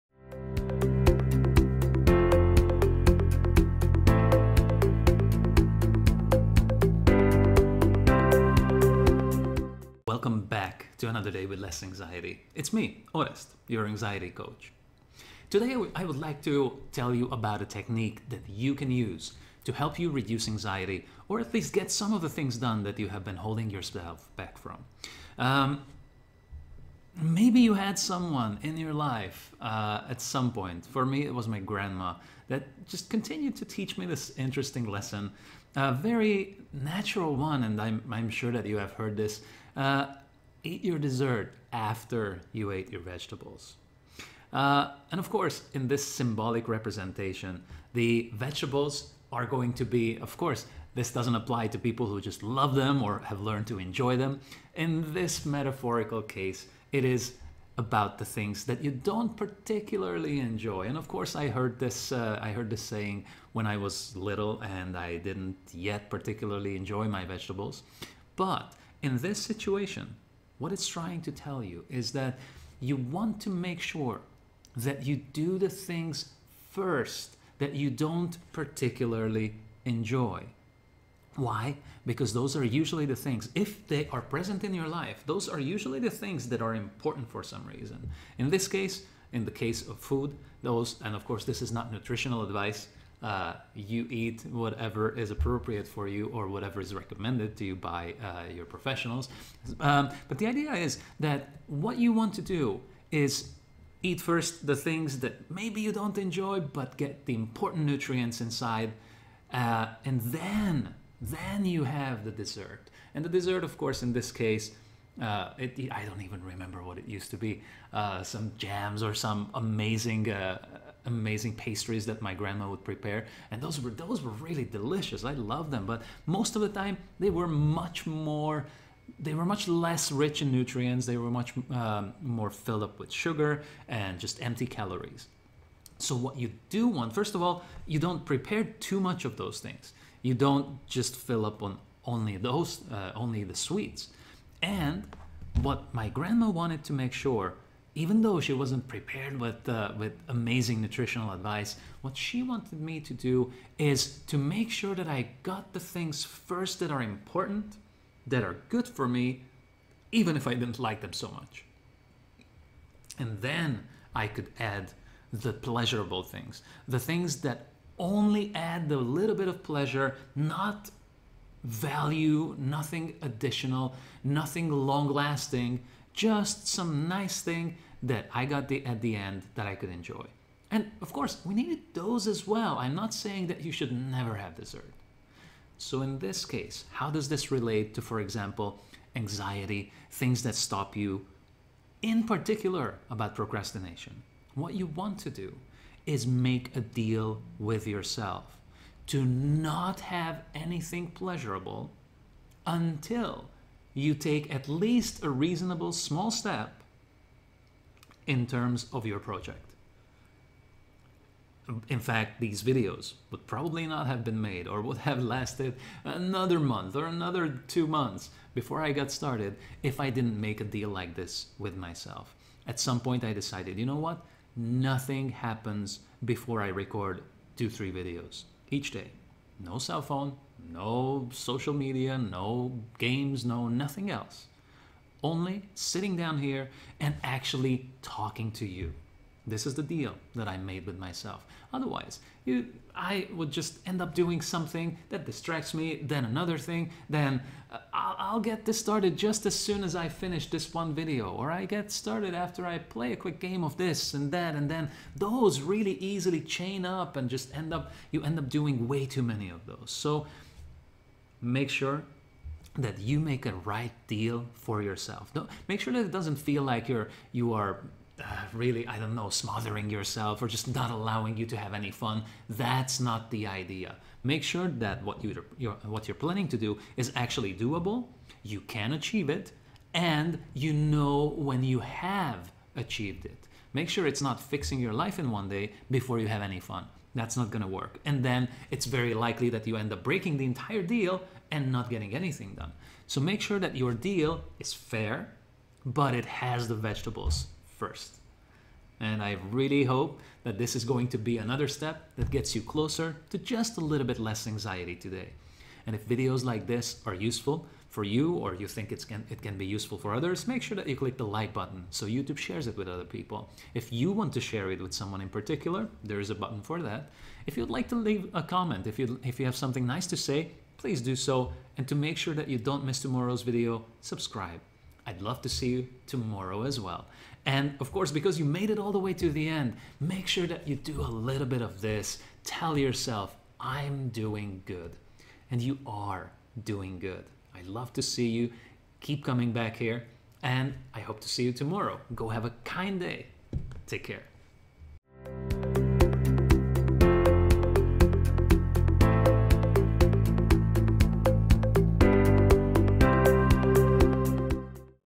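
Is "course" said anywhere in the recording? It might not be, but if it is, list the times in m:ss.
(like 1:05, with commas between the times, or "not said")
0:45, 0:50, 1:01, 1:31, 1:53, 3:01, 5:27.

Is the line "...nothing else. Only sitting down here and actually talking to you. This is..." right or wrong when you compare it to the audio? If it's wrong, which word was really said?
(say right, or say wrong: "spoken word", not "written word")
right.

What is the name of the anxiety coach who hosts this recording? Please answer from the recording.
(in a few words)
Orest.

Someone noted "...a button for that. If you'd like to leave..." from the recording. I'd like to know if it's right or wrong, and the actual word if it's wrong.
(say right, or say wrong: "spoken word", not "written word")
right.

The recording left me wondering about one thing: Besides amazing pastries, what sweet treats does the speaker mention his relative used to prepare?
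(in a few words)
Jams.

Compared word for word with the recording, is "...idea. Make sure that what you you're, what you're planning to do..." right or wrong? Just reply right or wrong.
right.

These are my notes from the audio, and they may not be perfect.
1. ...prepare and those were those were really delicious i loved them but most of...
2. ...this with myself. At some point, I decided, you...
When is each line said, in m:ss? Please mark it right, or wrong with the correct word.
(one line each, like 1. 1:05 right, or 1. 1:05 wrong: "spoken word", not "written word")
1. 2:02 right
2. 3:41 right.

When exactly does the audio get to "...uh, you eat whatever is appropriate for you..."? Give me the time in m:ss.
1:33.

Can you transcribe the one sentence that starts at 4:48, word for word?
And then it's very likely that you end up breaking the entire deal and not getting anything done.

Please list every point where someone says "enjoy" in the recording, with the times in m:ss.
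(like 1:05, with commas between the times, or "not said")
0:53, 1:00, 1:06, 1:19, 1:46, 2:59.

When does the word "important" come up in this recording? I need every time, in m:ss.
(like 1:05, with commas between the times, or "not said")
1:26, 1:47, 2:37.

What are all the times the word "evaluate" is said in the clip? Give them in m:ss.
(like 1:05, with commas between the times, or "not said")
not said.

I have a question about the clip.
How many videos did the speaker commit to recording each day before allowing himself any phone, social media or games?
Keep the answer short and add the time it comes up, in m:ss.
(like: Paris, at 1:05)
2 or 3, at 3:47.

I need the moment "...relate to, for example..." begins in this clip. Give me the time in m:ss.
3:07.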